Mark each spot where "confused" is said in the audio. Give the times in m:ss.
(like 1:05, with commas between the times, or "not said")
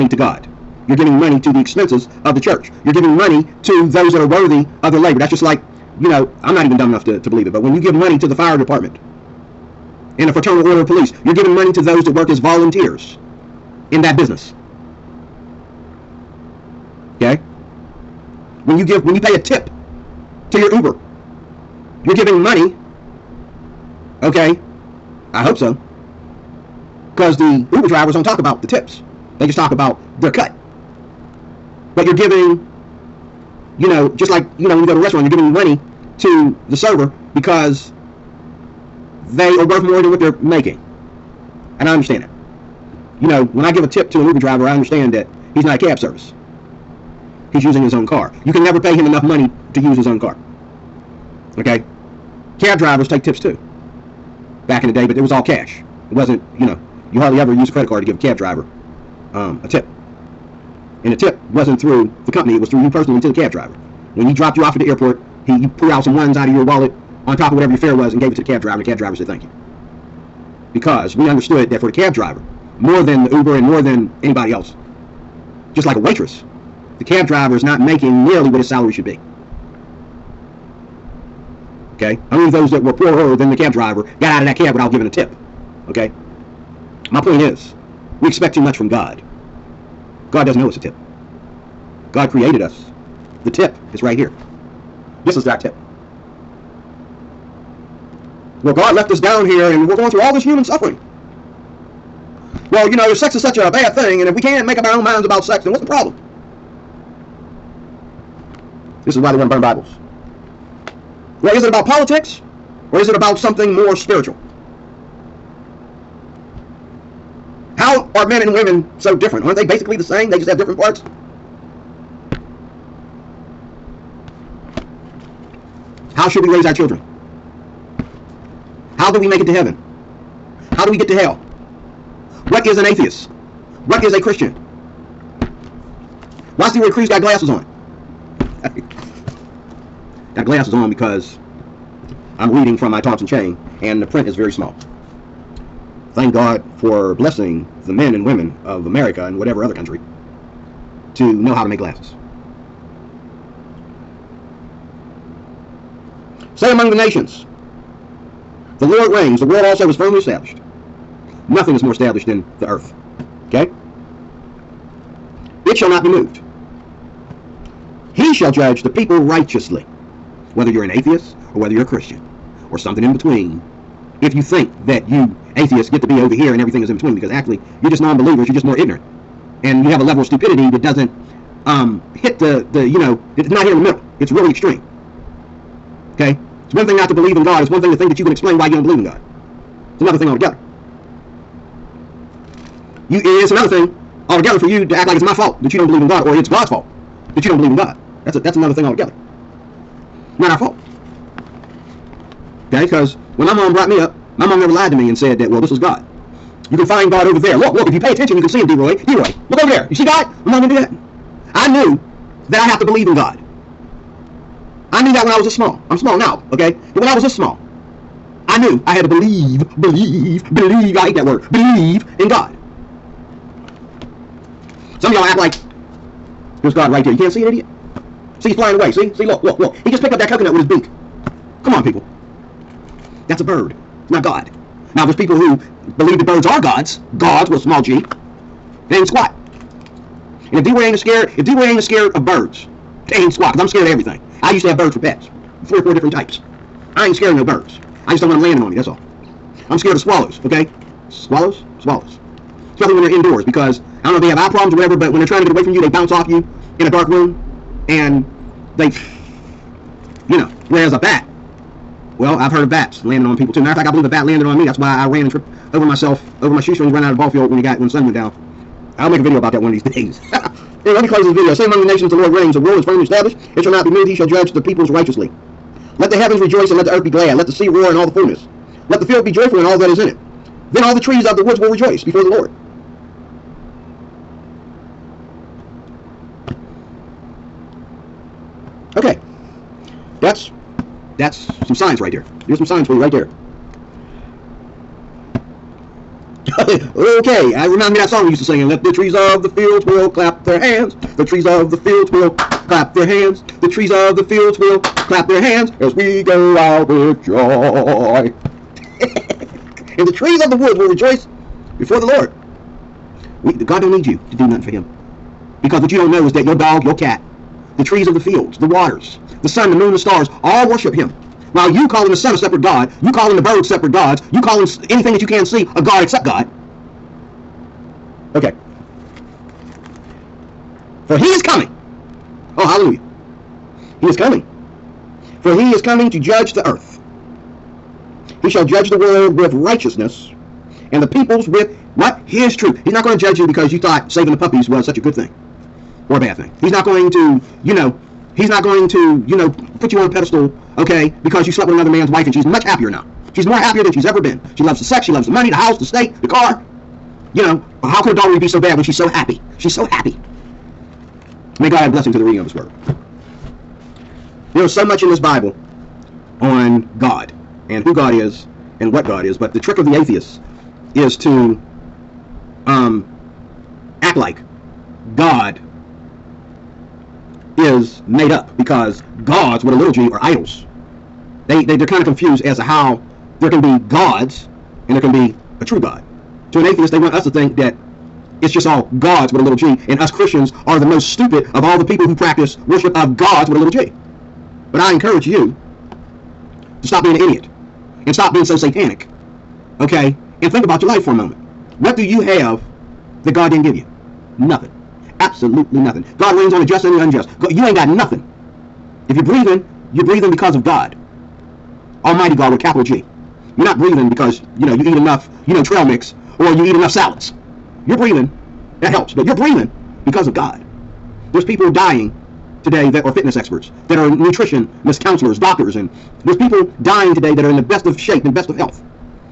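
6:22.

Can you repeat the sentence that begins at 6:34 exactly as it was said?
But I encourage you to stop being an idiot and stop being so satanic, okay?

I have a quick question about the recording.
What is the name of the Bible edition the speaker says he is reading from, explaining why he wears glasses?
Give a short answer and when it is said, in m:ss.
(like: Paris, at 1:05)
Thompson chain, at 2:22.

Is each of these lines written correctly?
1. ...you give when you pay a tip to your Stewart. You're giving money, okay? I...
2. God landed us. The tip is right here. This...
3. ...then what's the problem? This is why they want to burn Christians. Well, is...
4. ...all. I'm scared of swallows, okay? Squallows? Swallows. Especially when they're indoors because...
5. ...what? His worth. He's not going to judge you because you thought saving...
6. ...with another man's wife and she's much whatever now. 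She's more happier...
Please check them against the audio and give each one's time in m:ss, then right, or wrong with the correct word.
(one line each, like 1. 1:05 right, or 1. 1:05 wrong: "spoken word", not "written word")
1. 0:18 wrong: "Uber", not "Stewart"
2. 1:32 wrong: "created", not "landed"
3. 1:45 wrong: "Bibles", not "Christians"
4. 4:08 right
5. 5:41 wrong: "truth", not "worth"
6. 5:51 wrong: "happier", not "whatever".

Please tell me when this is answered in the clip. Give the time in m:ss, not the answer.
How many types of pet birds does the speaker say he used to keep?
4:05.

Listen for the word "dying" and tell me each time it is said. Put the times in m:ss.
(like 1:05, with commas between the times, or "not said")
7:01, 7:06.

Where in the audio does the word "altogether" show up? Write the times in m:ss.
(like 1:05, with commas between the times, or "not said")
3:10, 3:14, 3:18.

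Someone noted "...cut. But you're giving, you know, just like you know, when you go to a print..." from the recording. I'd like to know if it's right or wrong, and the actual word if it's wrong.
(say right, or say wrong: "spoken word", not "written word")
wrong: "restaurant", not "print".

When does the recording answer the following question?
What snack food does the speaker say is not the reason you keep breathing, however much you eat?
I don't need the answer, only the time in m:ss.
6:55.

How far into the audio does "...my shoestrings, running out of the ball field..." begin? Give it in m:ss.
4:26.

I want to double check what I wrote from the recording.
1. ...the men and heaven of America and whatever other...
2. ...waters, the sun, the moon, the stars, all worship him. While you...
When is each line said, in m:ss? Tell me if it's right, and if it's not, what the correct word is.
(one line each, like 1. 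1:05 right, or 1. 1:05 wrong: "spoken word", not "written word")
1. 2:27 wrong: "women", not "heaven"
2. 5:18 right.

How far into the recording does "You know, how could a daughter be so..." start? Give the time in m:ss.
5:57.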